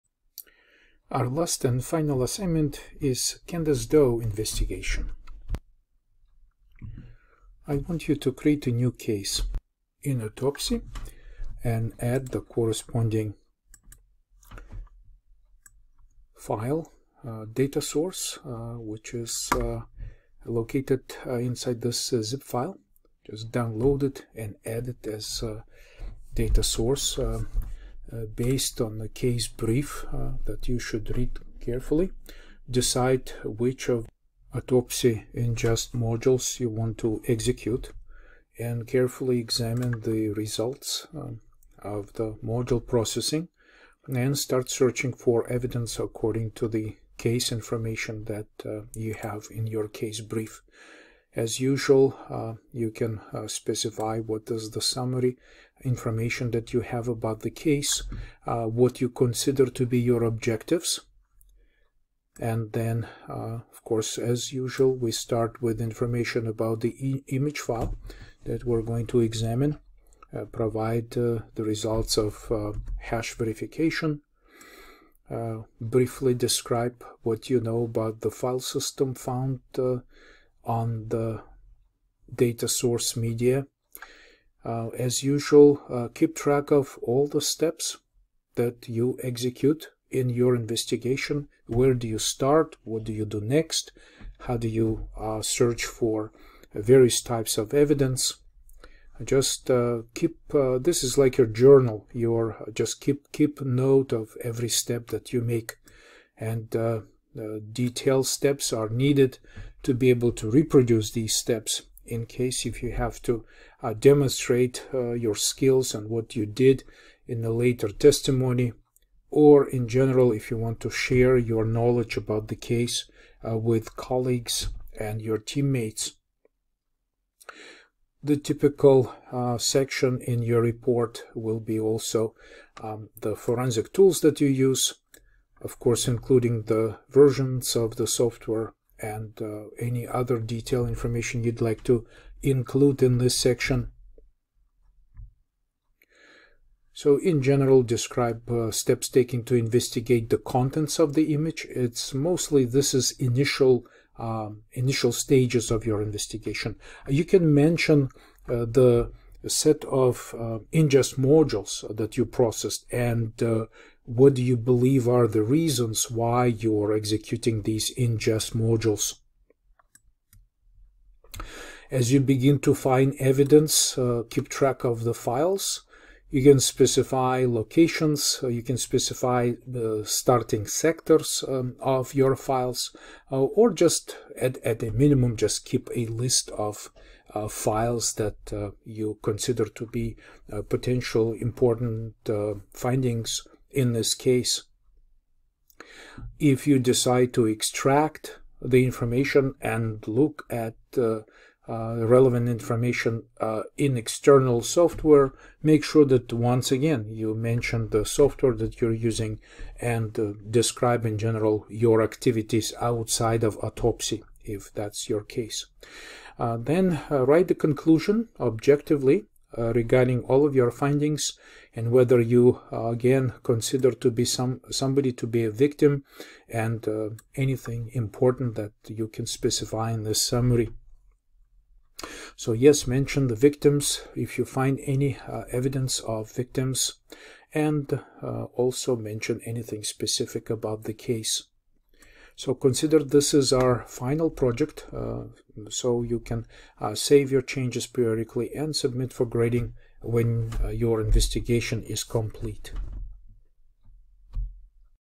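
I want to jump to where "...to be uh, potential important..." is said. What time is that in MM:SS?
03:09.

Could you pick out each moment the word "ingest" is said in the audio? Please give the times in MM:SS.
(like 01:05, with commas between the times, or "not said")
00:35, 02:40, 02:47.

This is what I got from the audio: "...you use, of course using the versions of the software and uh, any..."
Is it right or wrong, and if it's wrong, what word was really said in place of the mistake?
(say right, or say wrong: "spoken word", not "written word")
wrong: "including", not "using".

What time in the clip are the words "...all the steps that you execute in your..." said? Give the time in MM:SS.
01:27.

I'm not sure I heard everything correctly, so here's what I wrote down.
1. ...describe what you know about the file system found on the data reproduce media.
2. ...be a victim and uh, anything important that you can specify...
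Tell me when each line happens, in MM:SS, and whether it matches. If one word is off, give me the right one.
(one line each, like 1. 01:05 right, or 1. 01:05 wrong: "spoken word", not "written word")
1. 01:16 wrong: "source", not "reproduce"
2. 03:45 right.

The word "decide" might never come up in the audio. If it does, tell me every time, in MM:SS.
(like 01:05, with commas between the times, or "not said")
00:32, 03:16.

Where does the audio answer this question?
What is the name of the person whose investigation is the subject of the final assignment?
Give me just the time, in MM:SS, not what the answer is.
00:03.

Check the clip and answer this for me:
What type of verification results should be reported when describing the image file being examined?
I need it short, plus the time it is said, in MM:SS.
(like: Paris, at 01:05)
hash verification, at 01:12.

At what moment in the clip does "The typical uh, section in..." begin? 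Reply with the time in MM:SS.
02:08.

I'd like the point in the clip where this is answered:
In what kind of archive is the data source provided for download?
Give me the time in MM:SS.
00:22.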